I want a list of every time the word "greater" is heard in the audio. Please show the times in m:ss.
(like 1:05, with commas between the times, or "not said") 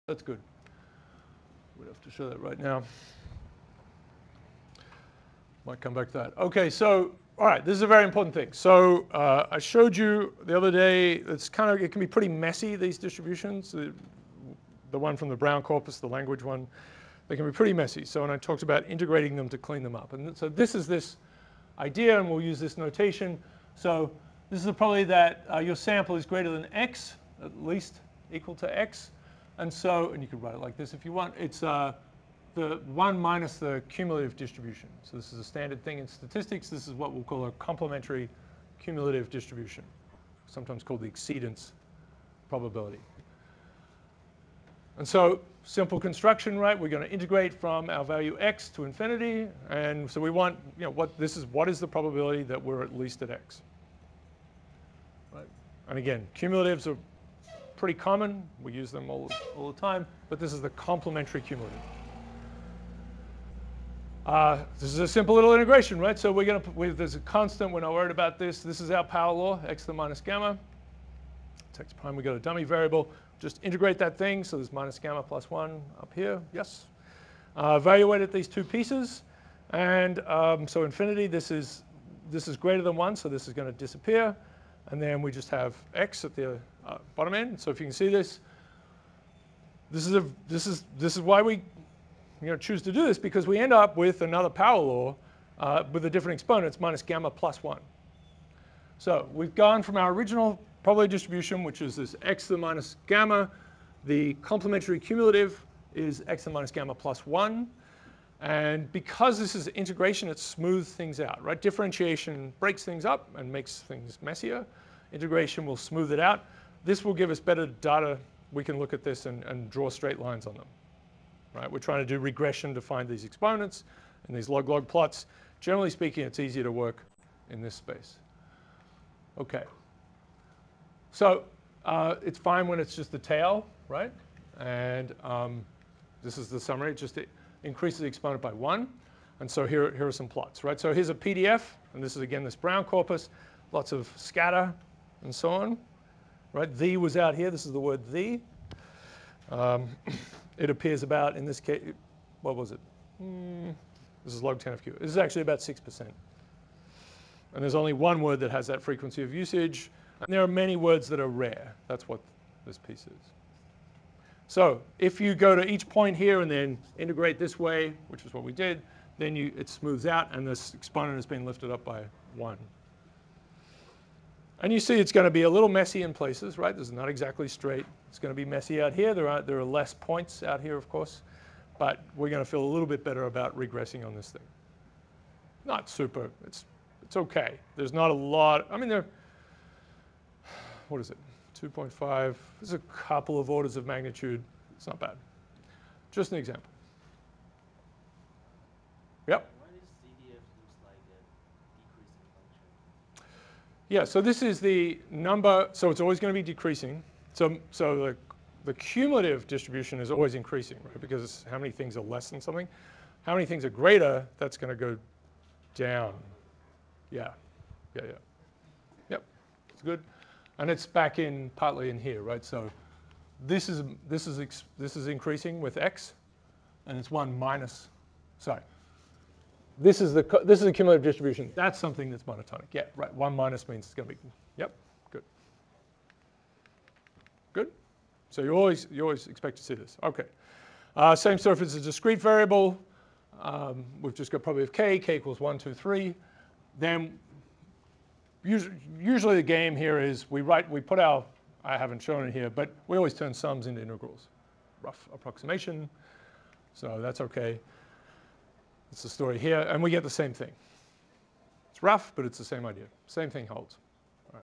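0:26, 1:22, 3:33.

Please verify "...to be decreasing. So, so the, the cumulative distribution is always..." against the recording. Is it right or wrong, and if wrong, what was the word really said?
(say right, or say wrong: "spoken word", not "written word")
right.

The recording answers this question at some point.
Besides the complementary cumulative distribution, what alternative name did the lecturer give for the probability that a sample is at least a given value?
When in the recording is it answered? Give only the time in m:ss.
0:41.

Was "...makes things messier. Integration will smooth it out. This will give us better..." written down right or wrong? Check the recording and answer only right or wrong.
right.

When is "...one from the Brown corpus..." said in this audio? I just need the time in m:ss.
0:14.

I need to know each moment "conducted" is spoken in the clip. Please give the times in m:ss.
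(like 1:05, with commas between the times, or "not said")
not said.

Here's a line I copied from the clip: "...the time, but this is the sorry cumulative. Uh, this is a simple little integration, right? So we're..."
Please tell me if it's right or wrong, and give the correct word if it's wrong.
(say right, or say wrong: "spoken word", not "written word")
wrong: "complementary", not "sorry".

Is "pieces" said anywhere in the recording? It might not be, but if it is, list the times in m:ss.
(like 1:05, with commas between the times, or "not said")
1:18, 2:42.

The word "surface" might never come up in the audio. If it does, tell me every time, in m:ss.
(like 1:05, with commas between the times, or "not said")
4:01.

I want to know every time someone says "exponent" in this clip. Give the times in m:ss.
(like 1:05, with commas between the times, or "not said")
1:36, 2:03, 2:18, 2:50.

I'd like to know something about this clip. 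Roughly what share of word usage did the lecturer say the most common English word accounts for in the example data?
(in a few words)
6%.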